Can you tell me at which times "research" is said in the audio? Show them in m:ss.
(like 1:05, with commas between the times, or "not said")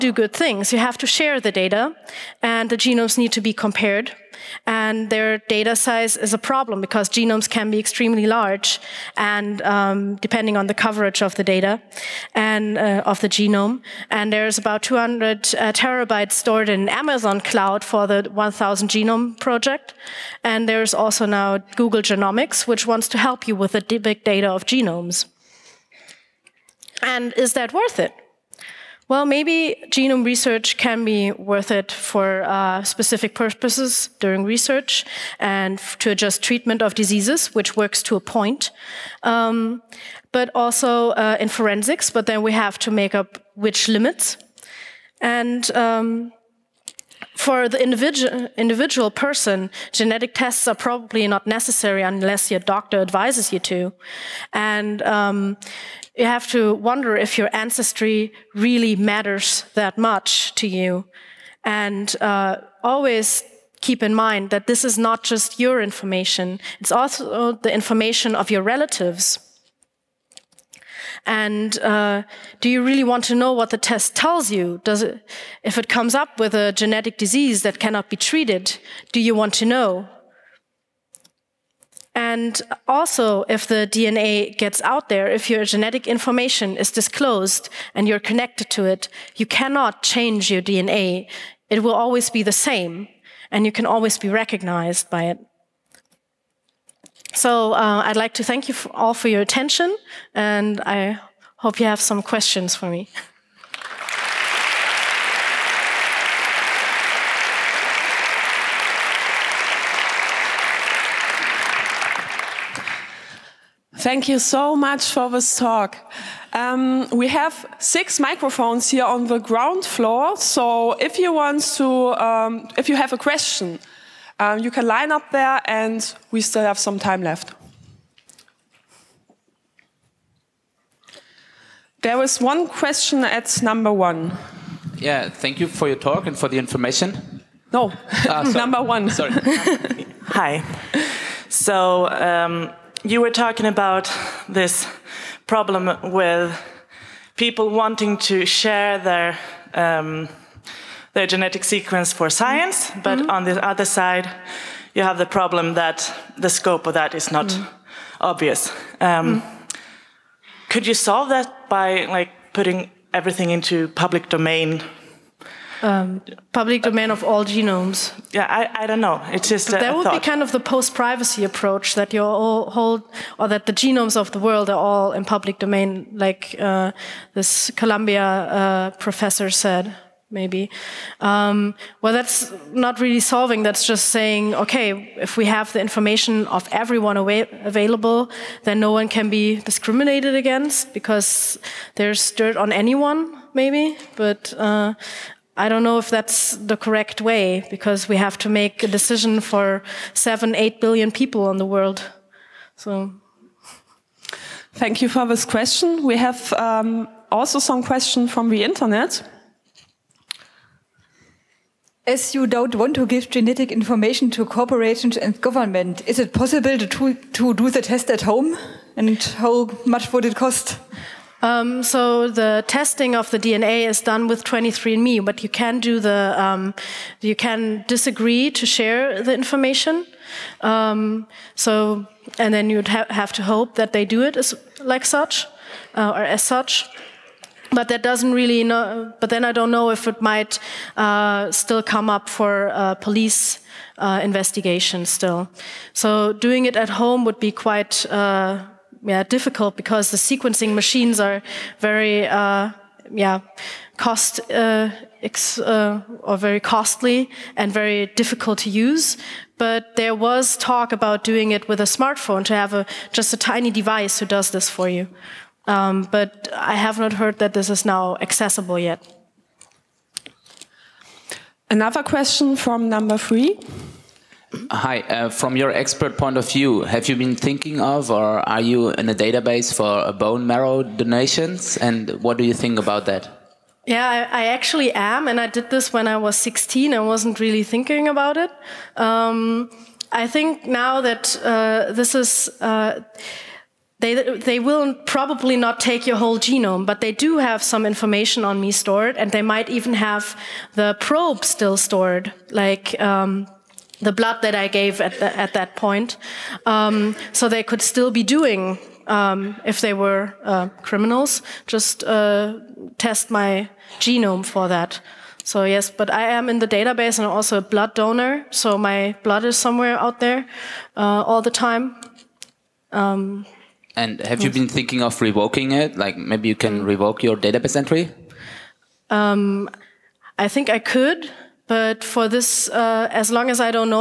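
0:30, 0:34.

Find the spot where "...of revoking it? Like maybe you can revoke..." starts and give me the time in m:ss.
5:25.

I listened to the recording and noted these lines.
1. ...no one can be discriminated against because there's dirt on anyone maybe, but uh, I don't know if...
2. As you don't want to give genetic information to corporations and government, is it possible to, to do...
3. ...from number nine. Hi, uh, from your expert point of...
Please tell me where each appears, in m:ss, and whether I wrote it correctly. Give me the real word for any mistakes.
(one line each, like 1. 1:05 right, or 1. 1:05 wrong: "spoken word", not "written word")
1. 3:08 right
2. 3:32 right
3. 4:32 wrong: "three", not "nine".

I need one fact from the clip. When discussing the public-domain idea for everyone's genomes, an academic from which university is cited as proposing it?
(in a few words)
Columbia.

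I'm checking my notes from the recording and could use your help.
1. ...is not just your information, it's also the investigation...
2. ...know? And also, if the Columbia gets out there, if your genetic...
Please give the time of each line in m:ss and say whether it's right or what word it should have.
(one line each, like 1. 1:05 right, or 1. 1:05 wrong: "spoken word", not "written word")
1. 1:04 wrong: "information", not "investigation"
2. 1:19 wrong: "DNA", not "Columbia".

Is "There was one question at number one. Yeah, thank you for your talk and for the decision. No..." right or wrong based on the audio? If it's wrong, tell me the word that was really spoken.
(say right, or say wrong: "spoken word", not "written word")
wrong: "information", not "decision".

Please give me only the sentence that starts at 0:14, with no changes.
And there's about 200 uh, terabytes stored in Amazon cloud for the 1000 genome project.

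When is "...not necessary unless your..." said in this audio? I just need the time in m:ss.
0:51.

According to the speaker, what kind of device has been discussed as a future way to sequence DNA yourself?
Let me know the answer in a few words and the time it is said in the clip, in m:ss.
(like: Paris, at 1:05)
A smartphone, at 4:21.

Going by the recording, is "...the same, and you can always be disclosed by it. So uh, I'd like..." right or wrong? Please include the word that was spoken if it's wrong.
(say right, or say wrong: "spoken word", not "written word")
wrong: "recognized", not "disclosed".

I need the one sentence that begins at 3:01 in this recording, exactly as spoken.
Um, well, that's not really solving.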